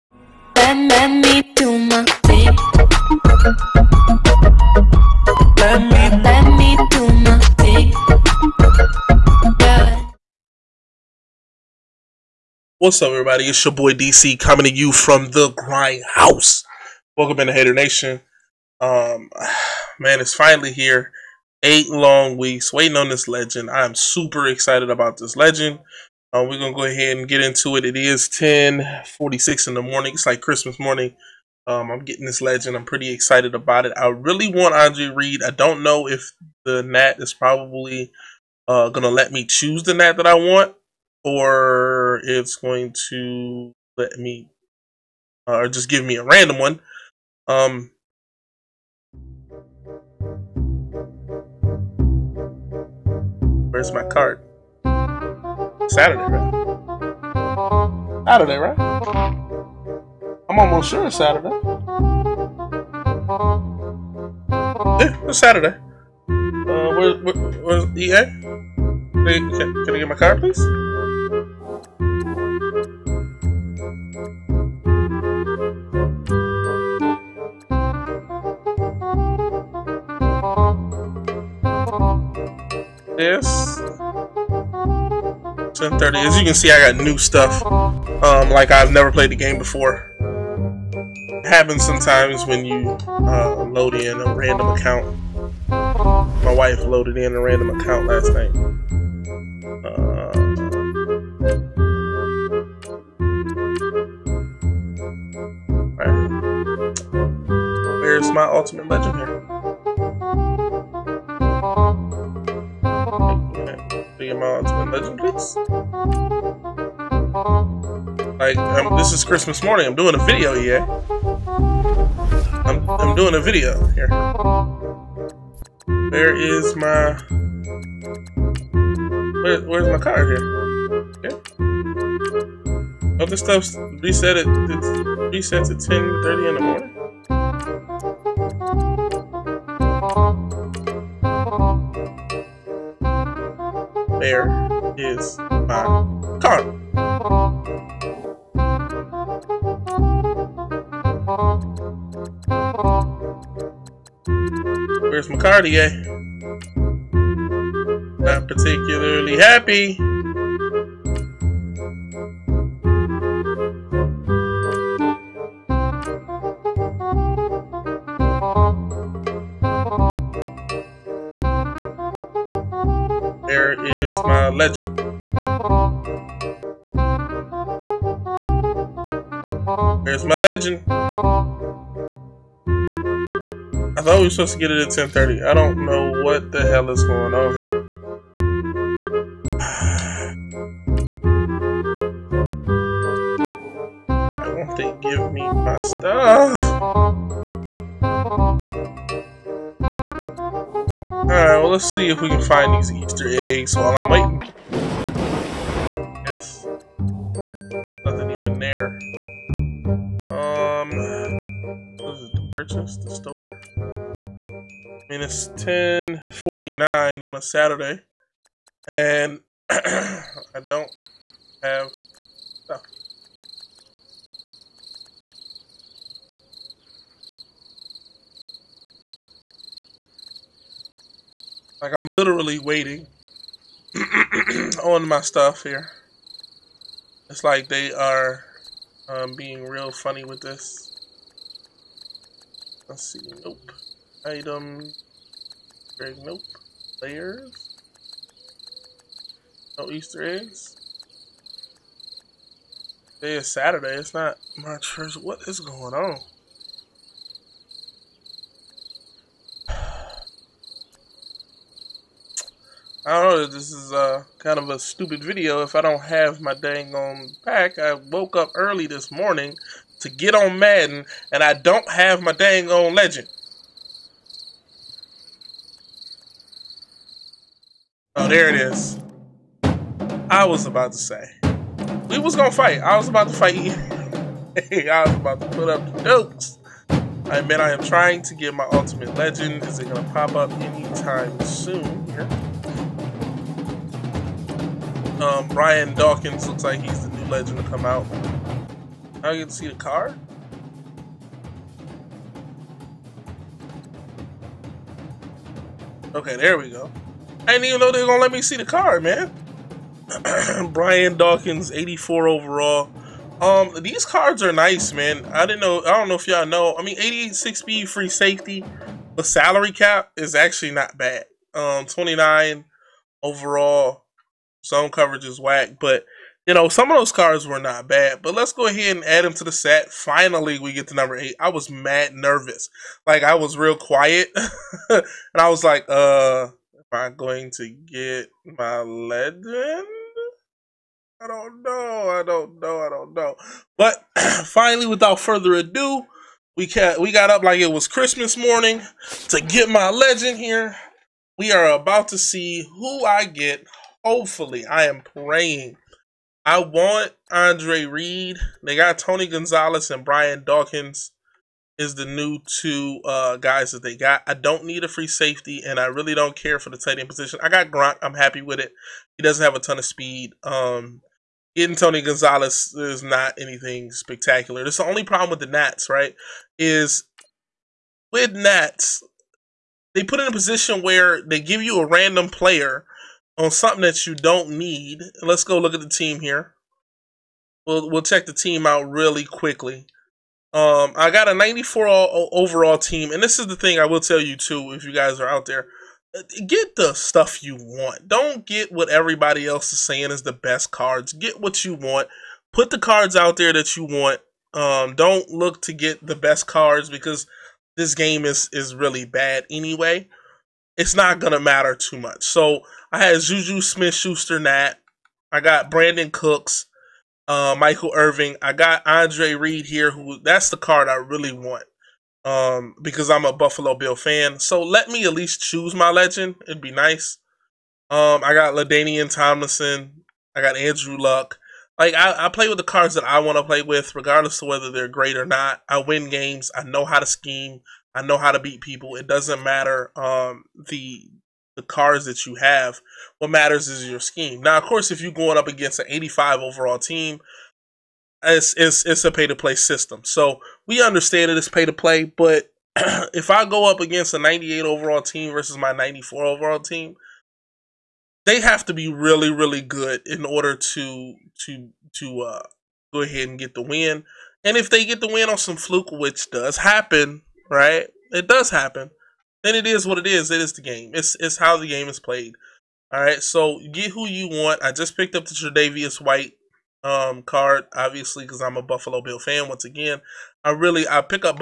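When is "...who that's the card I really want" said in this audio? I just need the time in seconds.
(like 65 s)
419 s.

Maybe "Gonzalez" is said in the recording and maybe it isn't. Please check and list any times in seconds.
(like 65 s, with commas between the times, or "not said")
359 s, 371 s.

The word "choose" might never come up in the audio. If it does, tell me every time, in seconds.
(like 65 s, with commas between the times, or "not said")
39 s, 425 s.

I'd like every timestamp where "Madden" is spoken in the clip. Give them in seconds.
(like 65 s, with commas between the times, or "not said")
270 s.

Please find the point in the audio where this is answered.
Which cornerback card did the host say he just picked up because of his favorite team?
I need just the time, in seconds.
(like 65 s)
475 s.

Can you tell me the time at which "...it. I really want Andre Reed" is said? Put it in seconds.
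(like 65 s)
33 s.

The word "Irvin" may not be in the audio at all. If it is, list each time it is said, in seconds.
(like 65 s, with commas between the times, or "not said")
417 s.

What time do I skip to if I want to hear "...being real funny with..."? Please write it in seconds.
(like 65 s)
239 s.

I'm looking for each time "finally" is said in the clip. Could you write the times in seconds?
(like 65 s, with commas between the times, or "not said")
20 s, 329 s, 344 s.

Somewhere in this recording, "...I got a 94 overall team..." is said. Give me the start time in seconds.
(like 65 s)
390 s.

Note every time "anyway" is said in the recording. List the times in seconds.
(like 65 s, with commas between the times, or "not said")
409 s.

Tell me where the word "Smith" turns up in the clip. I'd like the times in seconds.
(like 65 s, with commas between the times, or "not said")
413 s.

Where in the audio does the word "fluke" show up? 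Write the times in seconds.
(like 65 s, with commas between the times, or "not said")
465 s.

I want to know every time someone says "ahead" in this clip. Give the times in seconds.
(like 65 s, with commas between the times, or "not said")
26 s, 328 s, 462 s.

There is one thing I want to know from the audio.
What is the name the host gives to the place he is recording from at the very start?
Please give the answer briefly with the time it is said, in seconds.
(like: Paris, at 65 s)
the Grind House, at 15 s.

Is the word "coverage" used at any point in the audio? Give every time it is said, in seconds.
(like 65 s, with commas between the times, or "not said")
324 s.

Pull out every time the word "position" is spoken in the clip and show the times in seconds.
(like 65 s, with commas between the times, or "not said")
367 s, 380 s.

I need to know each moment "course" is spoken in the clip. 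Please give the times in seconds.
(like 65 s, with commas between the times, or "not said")
444 s.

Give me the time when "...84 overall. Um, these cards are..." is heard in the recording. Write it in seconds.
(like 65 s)
311 s.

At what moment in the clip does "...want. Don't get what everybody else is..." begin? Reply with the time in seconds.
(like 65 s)
397 s.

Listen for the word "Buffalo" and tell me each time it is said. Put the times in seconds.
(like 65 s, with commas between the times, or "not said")
423 s, 478 s.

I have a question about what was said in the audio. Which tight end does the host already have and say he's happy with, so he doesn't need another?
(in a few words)
Gronk.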